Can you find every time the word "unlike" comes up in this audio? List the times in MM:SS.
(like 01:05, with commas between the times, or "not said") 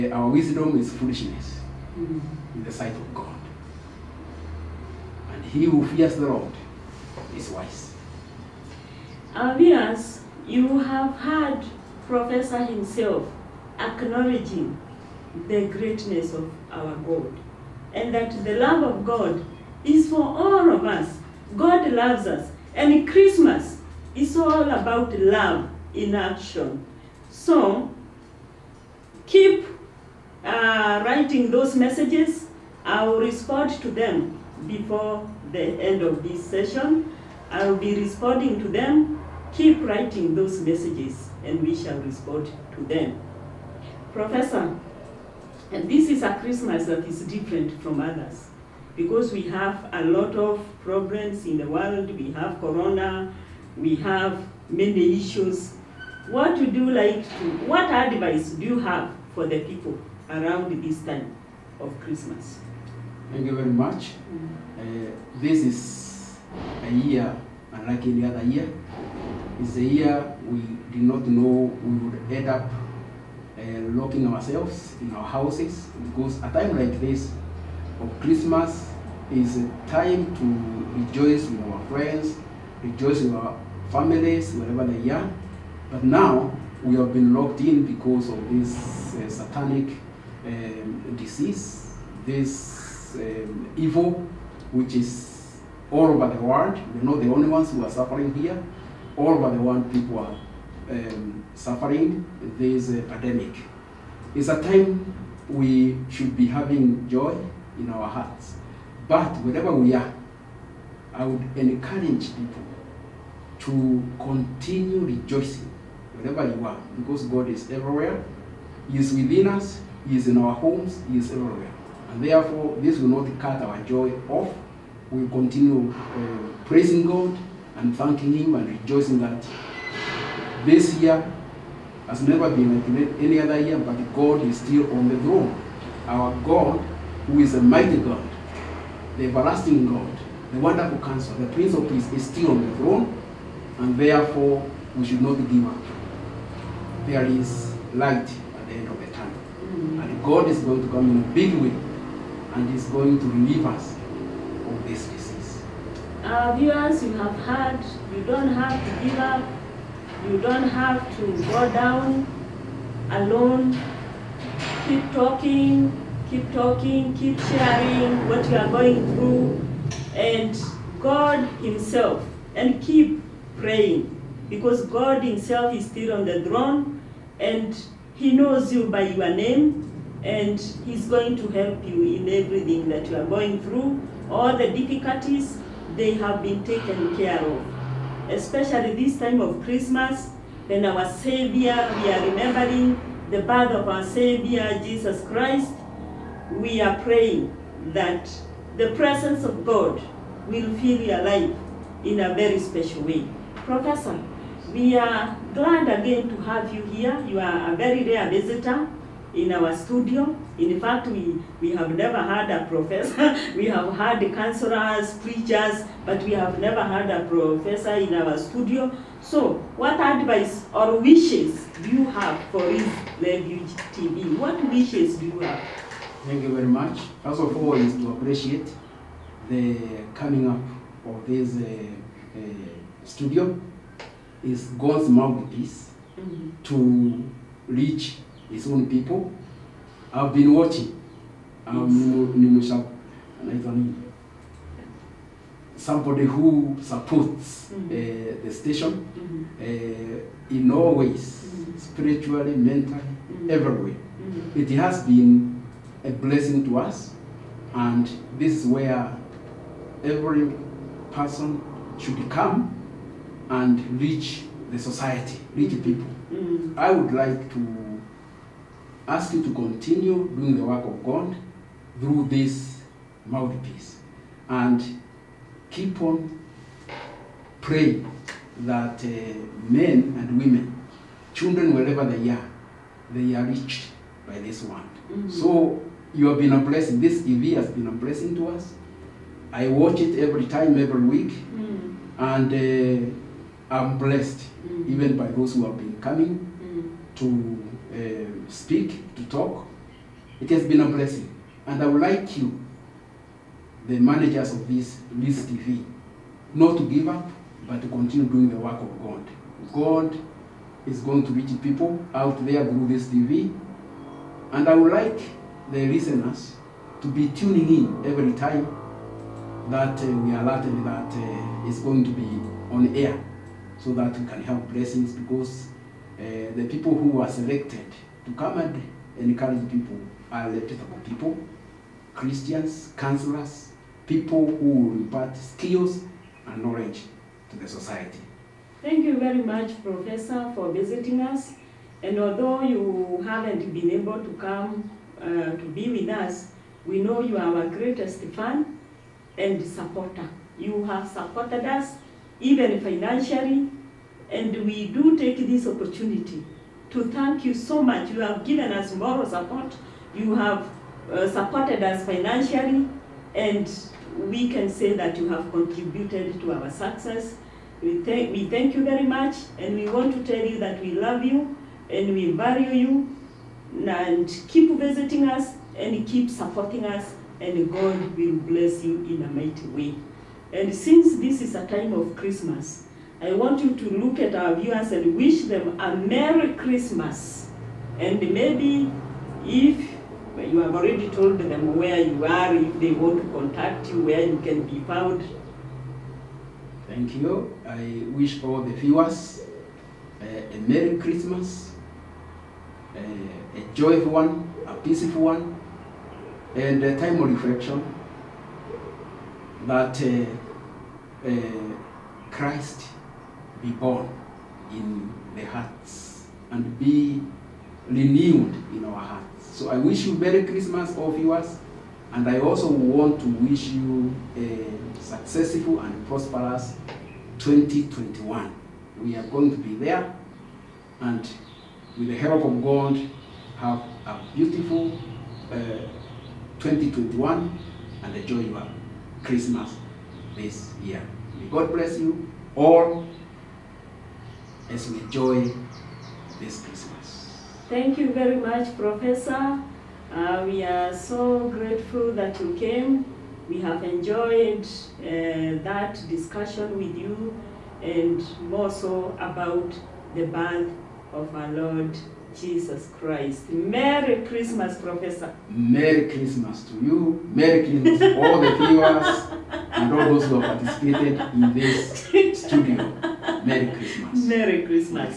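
01:07.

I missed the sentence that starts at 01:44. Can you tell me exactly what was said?
It's a time we should be having joy, in our hearts.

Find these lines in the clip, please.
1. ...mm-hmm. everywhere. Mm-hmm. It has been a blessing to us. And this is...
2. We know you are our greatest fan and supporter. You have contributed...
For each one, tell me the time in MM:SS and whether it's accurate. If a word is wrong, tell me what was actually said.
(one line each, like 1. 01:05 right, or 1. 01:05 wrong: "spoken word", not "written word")
1. 04:13 right
2. 05:46 wrong: "supported", not "contributed".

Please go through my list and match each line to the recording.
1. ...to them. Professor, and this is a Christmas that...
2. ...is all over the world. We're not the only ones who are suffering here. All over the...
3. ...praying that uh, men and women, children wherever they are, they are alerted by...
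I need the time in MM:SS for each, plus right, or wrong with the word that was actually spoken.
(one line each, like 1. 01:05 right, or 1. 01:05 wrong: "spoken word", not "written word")
1. 00:42 right
2. 01:34 right
3. 04:37 wrong: "reached", not "alerted".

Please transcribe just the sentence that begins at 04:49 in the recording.
I watch it every time, every week, mm.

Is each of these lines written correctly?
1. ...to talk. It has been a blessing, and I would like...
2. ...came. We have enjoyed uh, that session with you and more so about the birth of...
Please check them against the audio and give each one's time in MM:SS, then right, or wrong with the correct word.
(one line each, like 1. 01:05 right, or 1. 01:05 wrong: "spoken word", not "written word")
1. 04:59 right
2. 07:32 wrong: "discussion", not "session".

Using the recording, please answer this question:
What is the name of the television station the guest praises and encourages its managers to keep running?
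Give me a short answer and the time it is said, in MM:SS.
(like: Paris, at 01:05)
Refuge TV, at 03:42.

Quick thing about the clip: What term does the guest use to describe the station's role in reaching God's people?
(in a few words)
God's mouthpiece.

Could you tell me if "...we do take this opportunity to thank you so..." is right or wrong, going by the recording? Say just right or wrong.
right.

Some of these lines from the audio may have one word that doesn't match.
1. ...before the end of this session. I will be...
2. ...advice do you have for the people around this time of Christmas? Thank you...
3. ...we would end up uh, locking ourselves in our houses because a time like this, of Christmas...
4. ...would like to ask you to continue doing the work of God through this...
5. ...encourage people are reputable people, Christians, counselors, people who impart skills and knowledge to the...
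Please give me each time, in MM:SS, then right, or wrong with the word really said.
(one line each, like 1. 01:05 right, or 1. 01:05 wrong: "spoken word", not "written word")
1. 00:34 right
2. 00:57 right
3. 01:11 right
4. 04:26 right
5. 05:29 right.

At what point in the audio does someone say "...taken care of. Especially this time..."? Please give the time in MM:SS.
03:06.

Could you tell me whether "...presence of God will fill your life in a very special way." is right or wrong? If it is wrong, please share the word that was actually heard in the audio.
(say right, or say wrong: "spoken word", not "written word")
right.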